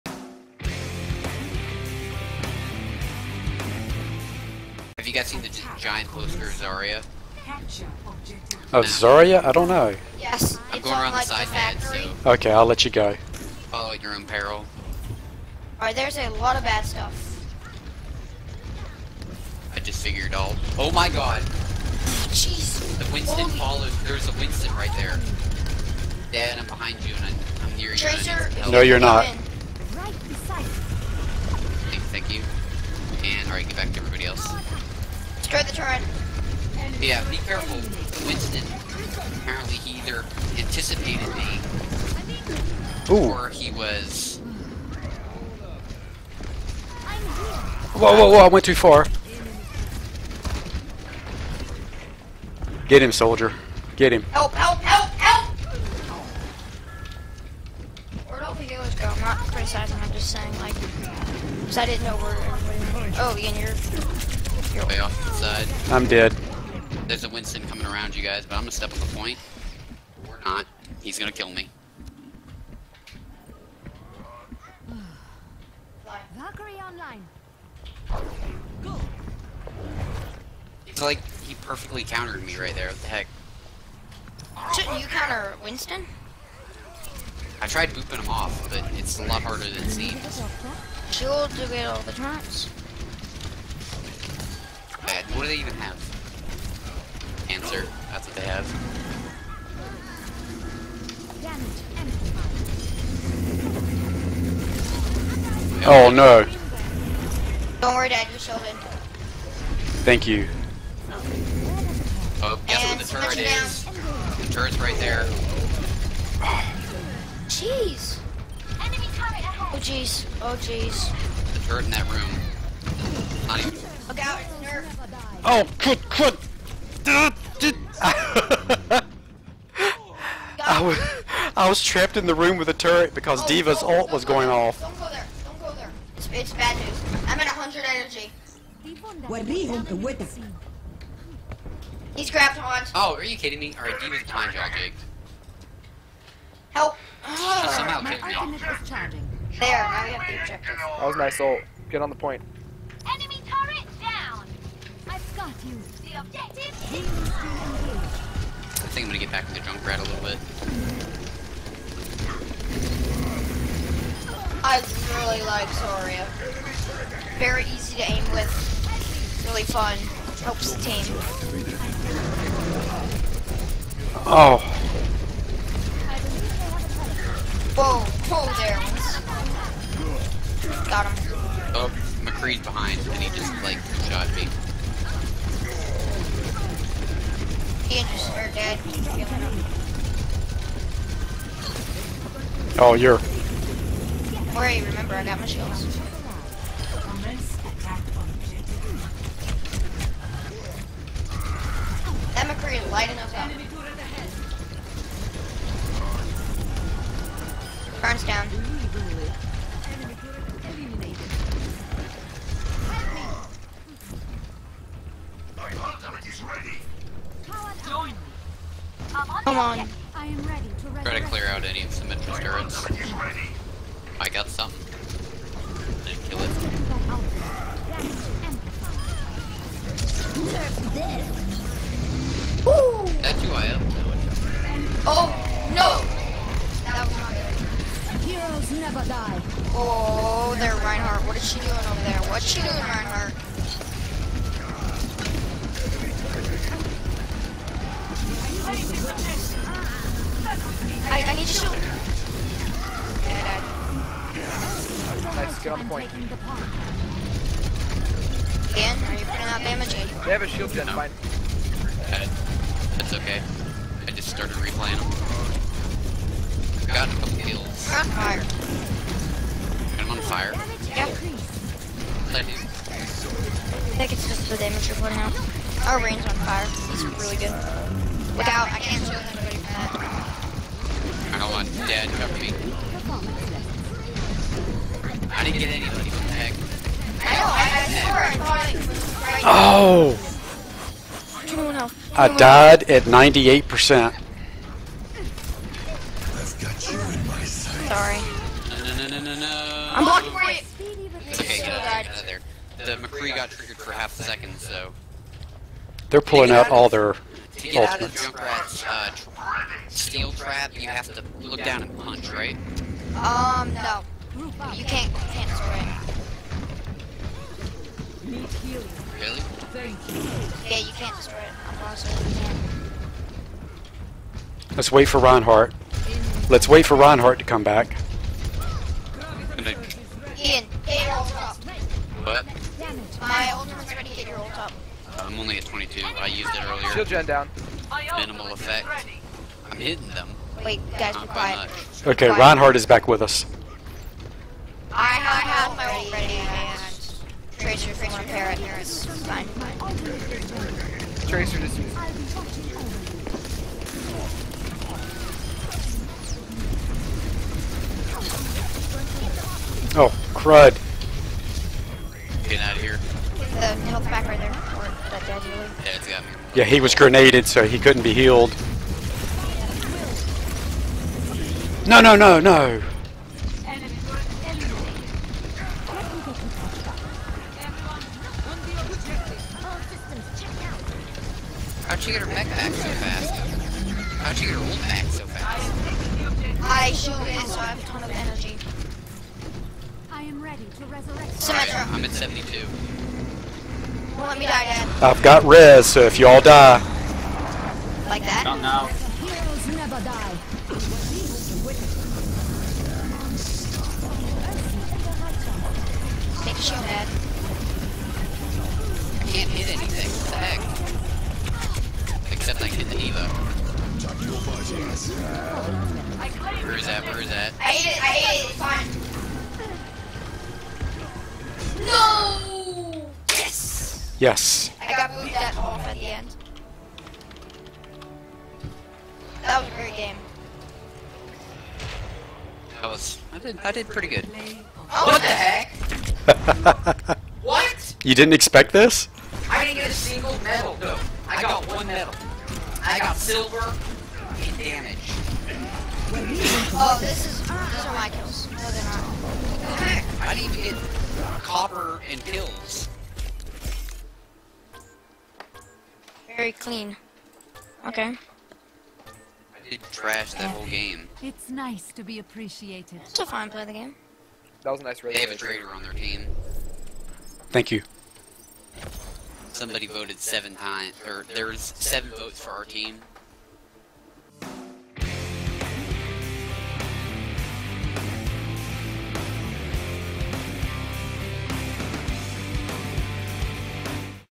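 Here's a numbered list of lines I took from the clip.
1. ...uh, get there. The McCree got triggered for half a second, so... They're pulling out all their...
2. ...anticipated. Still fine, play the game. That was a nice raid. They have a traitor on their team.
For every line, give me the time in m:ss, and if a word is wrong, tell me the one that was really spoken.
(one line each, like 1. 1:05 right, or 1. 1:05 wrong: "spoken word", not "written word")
1. 5:01 right
2. 7:42 wrong: "appreciated", not "anticipated".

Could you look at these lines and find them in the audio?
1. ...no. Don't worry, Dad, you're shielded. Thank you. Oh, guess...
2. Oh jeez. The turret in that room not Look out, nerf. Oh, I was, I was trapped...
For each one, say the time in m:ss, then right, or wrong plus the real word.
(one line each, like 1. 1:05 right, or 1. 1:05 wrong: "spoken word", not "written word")
1. 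1:46 right
2. 2:00 right.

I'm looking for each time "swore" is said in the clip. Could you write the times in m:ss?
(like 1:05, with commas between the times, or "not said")
4:47.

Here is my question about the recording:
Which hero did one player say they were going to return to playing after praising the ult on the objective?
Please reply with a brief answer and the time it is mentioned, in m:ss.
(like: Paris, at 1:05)
Junkrat, at 2:39.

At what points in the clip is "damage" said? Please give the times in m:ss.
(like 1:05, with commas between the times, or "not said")
4:19, 4:34, 7:24.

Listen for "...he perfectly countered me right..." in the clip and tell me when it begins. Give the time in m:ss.
1:21.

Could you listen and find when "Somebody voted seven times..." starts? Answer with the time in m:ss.
7:49.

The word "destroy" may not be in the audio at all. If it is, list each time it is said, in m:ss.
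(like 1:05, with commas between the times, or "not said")
0:35, 5:21.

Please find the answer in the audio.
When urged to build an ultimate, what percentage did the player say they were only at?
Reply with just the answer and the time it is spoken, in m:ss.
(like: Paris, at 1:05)
22, at 5:35.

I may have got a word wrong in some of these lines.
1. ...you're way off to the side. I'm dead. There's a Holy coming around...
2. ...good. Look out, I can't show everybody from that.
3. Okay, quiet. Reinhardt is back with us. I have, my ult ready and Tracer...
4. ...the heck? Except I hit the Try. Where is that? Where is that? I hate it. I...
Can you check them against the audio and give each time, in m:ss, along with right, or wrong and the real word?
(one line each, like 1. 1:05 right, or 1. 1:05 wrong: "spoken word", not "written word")
1. 1:03 wrong: "Winston", not "Holy"
2. 4:37 wrong: "anybody", not "everybody"
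3. 5:42 right
4. 6:50 wrong: "Evo", not "Try".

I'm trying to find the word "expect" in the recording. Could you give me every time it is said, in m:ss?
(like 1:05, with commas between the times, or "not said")
7:18.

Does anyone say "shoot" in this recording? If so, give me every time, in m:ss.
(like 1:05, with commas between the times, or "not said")
4:11, 6:26.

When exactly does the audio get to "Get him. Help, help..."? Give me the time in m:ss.
0:53.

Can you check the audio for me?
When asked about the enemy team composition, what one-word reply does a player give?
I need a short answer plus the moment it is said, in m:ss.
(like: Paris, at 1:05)
Answer, at 1:37.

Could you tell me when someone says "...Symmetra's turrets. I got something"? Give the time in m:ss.
3:42.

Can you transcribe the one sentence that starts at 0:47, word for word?
Whoa, whoa, whoa, I went too far.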